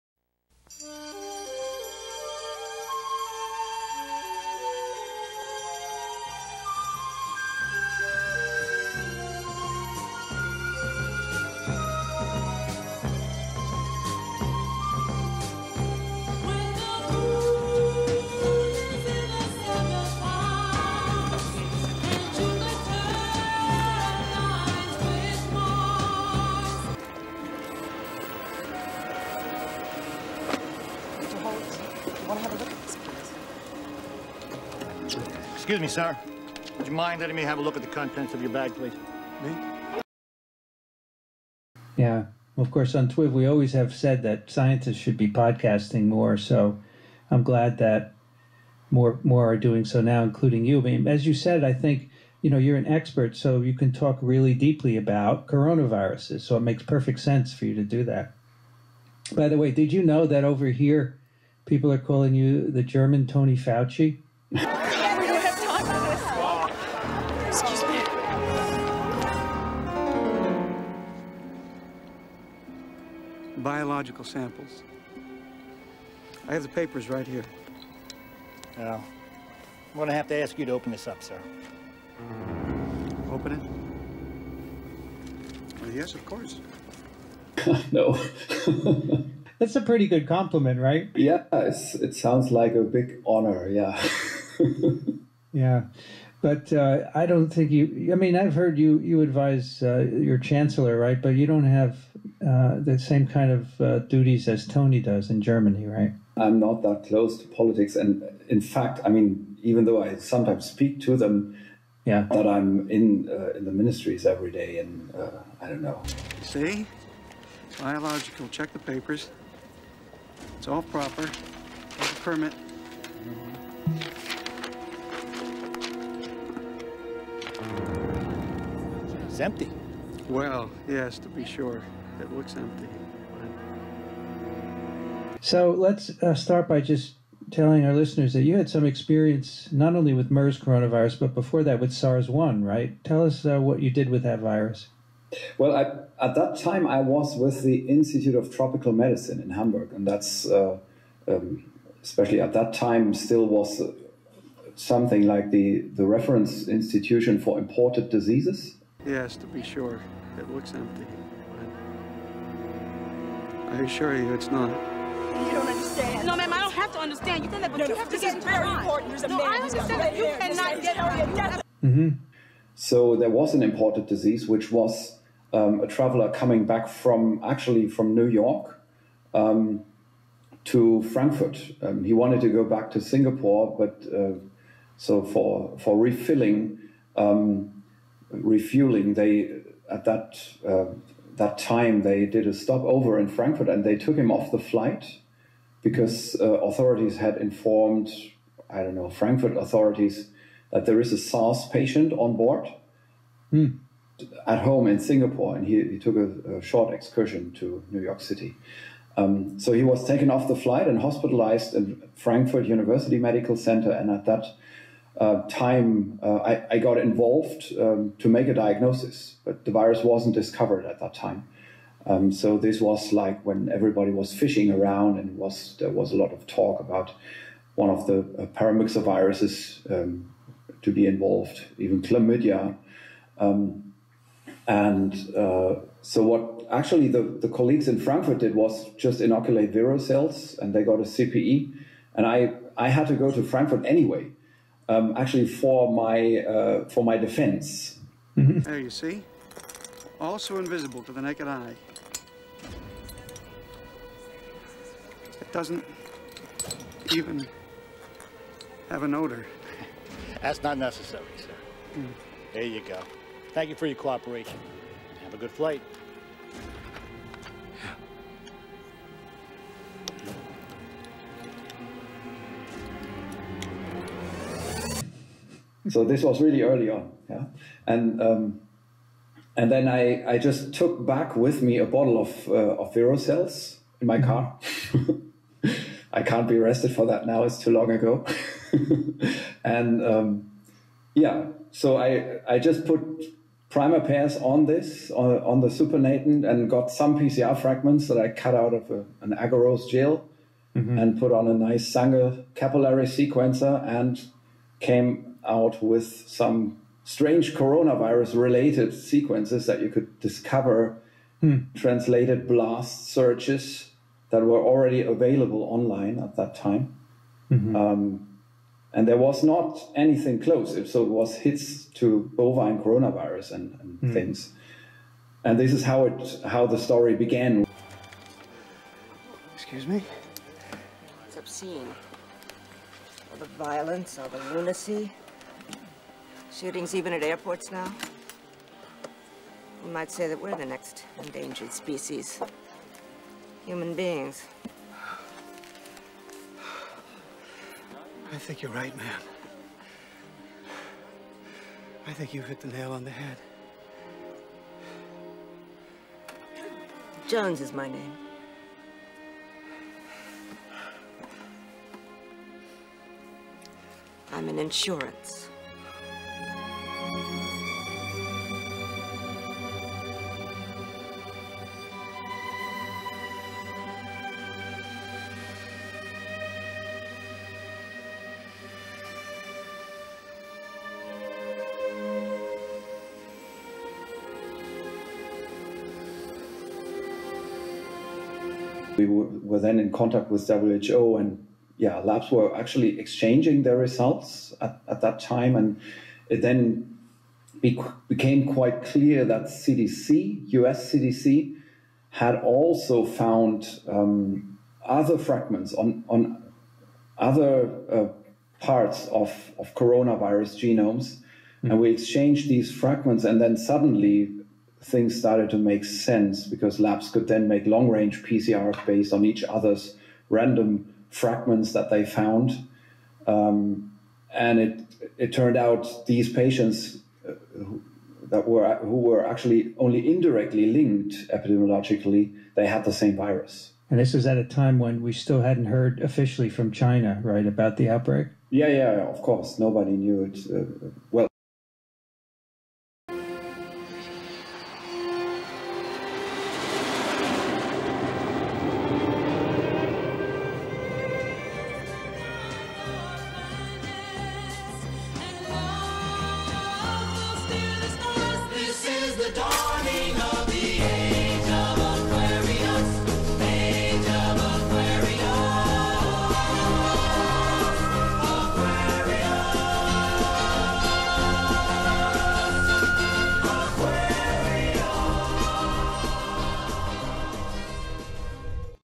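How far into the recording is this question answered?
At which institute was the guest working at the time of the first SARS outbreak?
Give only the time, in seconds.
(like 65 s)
147 s.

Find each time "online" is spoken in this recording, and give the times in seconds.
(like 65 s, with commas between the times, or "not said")
315 s.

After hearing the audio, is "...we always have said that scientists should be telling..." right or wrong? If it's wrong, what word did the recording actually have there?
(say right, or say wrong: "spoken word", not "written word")
wrong: "podcasting", not "telling".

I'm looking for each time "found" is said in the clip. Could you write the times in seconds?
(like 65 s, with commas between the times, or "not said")
403 s, 422 s.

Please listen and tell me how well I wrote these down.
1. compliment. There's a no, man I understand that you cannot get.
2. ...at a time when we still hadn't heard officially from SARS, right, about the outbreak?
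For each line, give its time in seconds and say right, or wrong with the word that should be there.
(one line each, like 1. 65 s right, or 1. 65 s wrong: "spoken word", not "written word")
1. 168 s wrong: "important", not "compliment"
2. 434 s wrong: "China", not "SARS".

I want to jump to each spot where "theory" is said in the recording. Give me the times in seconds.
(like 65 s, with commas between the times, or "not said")
not said.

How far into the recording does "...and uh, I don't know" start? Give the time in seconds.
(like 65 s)
114 s.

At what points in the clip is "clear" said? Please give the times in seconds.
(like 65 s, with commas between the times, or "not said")
398 s.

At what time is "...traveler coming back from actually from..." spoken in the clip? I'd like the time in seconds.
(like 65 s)
175 s.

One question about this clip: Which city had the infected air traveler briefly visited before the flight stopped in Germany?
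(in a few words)
New York City.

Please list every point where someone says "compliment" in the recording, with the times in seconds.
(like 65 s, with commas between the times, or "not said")
90 s.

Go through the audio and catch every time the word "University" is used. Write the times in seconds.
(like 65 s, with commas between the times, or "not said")
212 s.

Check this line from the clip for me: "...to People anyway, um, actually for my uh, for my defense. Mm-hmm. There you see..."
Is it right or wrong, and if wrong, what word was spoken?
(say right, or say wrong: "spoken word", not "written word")
wrong: "Frankfurt", not "People".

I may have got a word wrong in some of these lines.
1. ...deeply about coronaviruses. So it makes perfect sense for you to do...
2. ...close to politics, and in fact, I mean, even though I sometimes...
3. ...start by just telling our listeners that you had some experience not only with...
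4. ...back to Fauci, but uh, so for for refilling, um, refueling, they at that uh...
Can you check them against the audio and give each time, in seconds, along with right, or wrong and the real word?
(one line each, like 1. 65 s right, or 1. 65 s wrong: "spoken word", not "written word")
1. 54 s right
2. 107 s right
3. 136 s right
4. 182 s wrong: "Singapore", not "Fauci".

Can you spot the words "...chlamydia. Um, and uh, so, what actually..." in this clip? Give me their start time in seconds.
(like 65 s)
232 s.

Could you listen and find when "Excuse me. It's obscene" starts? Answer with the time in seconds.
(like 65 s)
329 s.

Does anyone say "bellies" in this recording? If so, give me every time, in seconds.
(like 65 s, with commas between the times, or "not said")
not said.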